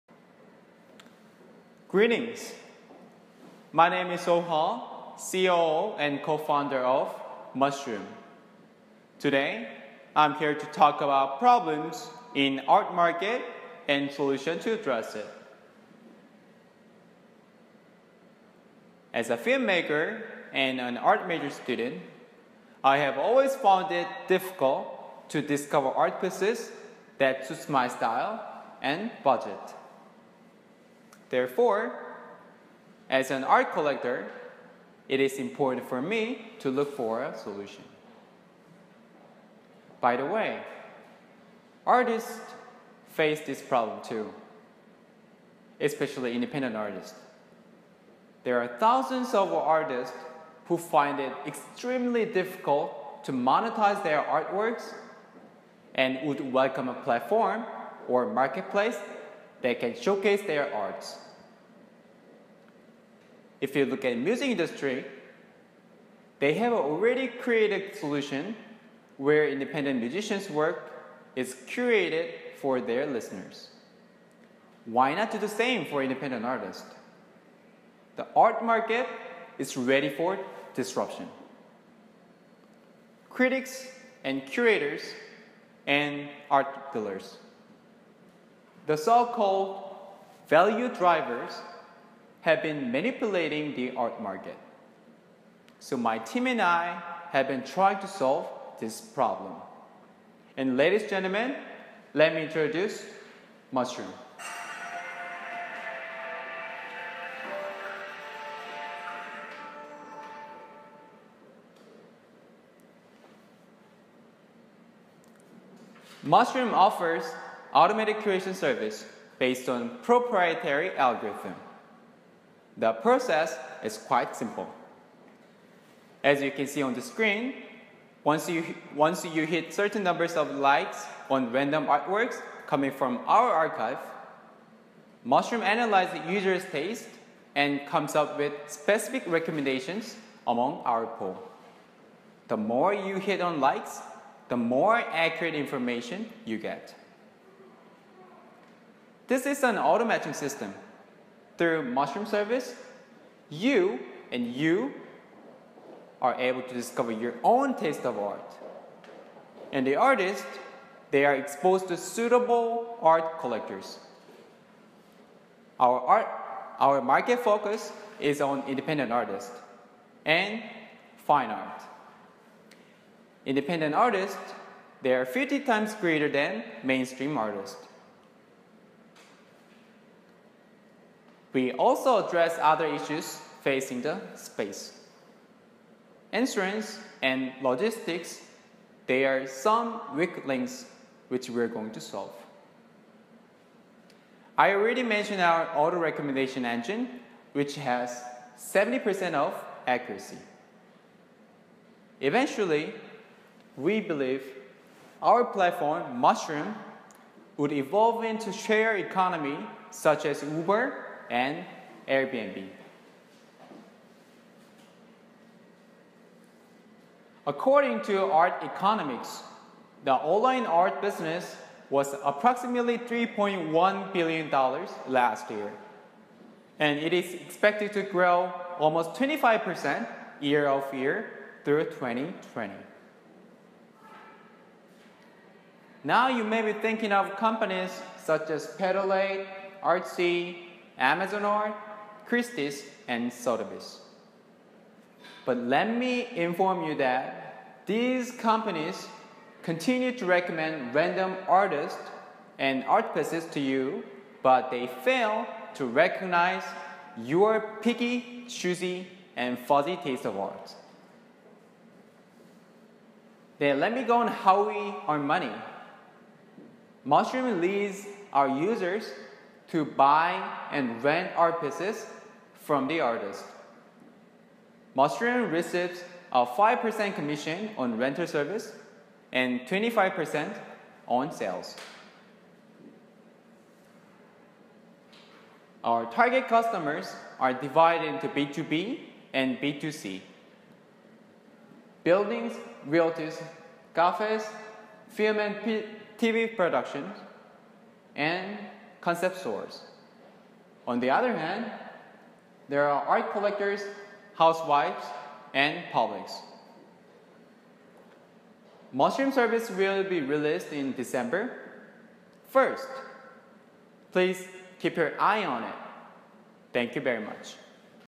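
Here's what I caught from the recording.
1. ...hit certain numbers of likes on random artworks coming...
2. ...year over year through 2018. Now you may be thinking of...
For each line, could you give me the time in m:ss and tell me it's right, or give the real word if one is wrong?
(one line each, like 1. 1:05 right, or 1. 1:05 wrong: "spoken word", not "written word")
1. 2:09 right
2. 3:50 wrong: "2020", not "2018".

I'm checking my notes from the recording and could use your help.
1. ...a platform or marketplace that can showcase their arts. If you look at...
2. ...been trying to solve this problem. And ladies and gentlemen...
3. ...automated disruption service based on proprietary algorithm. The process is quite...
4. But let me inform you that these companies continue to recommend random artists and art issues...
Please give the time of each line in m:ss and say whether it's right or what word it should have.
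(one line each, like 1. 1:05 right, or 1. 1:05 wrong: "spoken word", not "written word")
1. 0:56 right
2. 1:37 right
3. 1:57 wrong: "curation", not "disruption"
4. 4:05 wrong: "pieces", not "issues".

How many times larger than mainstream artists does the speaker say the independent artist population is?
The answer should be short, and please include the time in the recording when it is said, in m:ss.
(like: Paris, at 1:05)
50 times, at 2:55.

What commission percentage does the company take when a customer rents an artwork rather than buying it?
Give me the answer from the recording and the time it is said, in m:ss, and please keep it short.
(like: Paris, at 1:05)
5%, at 4:36.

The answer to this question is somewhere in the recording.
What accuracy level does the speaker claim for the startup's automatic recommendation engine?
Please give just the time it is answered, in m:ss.
3:18.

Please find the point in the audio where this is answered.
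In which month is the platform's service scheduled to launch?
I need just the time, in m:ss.
5:10.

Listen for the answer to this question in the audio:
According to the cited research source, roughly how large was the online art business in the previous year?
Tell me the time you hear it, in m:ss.
3:42.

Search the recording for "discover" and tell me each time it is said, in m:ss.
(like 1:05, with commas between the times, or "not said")
0:25, 2:36.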